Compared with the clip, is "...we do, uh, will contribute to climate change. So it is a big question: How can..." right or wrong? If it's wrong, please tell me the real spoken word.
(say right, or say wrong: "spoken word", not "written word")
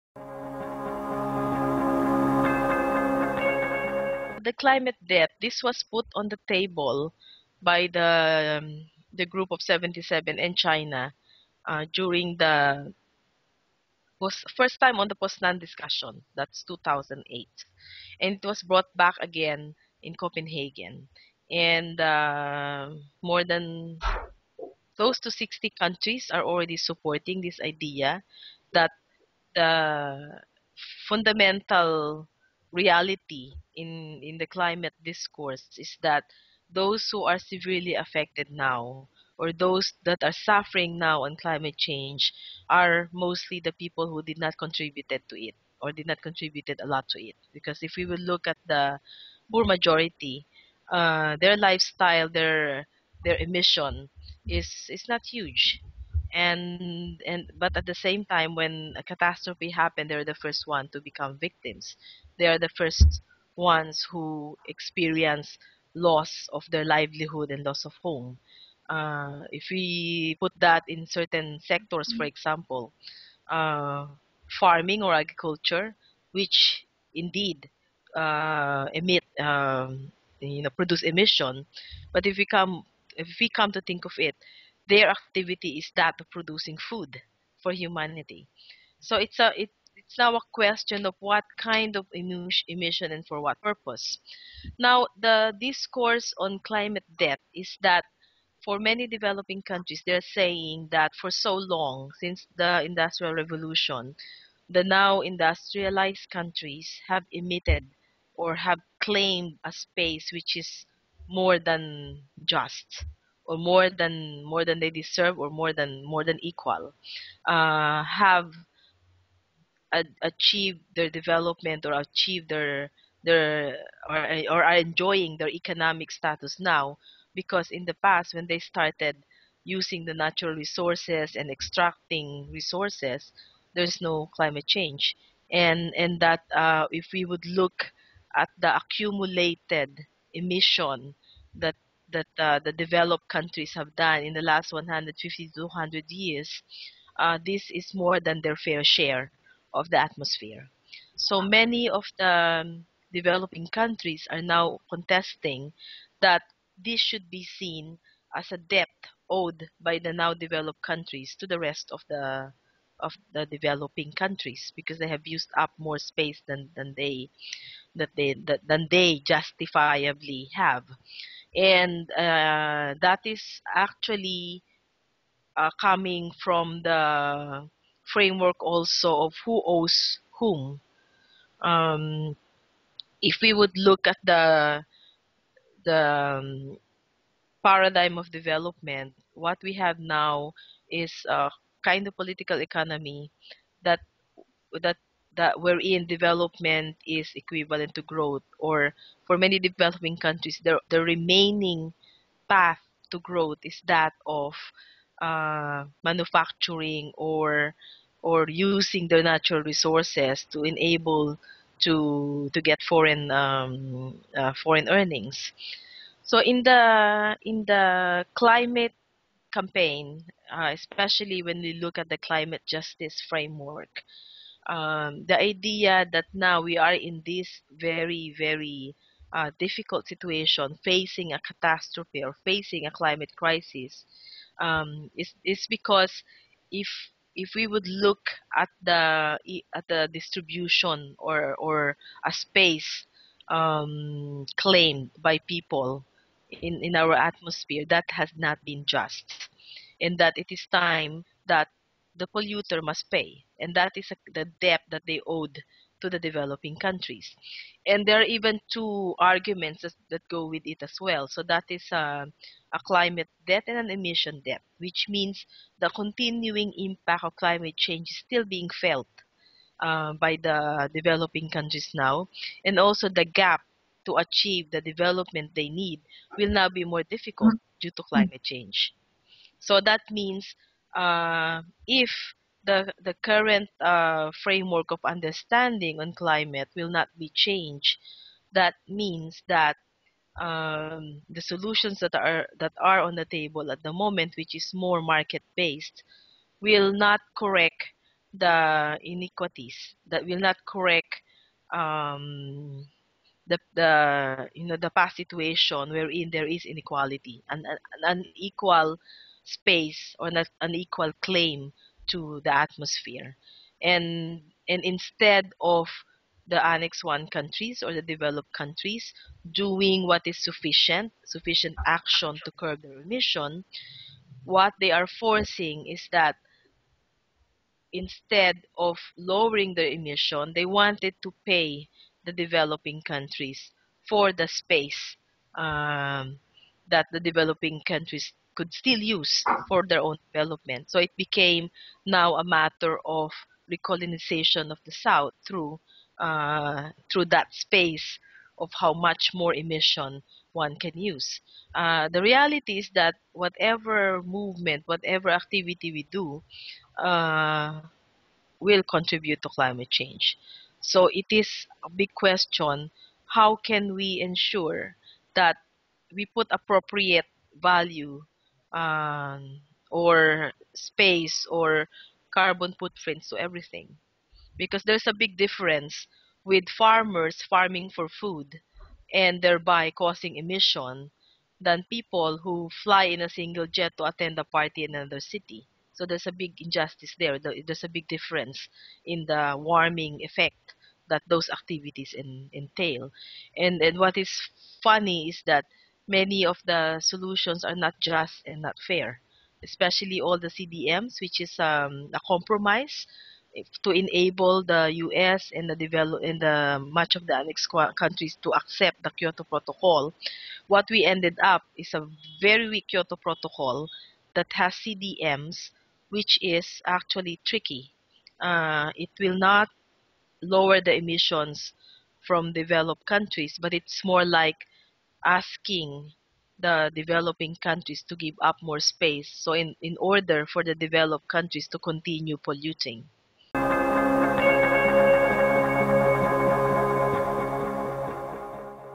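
right.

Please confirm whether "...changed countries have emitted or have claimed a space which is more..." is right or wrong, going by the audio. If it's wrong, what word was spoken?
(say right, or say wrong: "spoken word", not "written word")
wrong: "industrialized", not "changed".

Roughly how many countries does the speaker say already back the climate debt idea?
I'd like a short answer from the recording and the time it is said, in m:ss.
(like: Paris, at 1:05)
60, at 0:25.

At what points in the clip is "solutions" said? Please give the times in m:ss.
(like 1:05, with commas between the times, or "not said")
4:51, 6:36.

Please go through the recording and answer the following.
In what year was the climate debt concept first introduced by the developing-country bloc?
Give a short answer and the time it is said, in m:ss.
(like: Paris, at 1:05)
2008, at 0:16.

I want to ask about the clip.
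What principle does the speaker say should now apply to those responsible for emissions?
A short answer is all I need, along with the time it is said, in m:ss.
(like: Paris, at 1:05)
the polluter must pay, at 4:12.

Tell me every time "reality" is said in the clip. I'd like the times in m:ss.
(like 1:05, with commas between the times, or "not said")
0:32, 5:52.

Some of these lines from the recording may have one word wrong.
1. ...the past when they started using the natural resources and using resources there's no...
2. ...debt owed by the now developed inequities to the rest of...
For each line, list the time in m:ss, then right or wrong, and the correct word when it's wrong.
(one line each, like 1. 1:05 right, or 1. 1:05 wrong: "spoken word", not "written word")
1. 2:07 wrong: "extracting", not "using"
2. 2:38 wrong: "countries", not "inequities".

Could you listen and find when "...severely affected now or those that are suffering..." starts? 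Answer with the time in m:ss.
0:37.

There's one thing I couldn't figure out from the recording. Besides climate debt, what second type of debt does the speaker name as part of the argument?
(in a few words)
emission debt.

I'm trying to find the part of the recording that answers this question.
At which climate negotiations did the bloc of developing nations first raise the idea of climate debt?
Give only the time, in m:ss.
0:15.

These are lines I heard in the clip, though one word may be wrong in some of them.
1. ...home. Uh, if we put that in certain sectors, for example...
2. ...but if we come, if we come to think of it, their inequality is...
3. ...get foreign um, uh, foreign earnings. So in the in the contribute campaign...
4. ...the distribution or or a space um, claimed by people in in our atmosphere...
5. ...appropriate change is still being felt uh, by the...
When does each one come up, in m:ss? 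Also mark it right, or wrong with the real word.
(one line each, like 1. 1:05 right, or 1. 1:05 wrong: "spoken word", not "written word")
1. 1:08 right
2. 1:22 wrong: "activity", not "inequality"
3. 3:32 wrong: "climate", not "contribute"
4. 3:59 right
5. 4:27 wrong: "climate", not "appropriate".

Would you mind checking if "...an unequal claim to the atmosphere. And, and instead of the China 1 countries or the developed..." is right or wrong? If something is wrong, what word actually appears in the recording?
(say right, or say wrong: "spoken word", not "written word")
wrong: "Annex", not "China".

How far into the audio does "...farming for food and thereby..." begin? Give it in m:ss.
6:17.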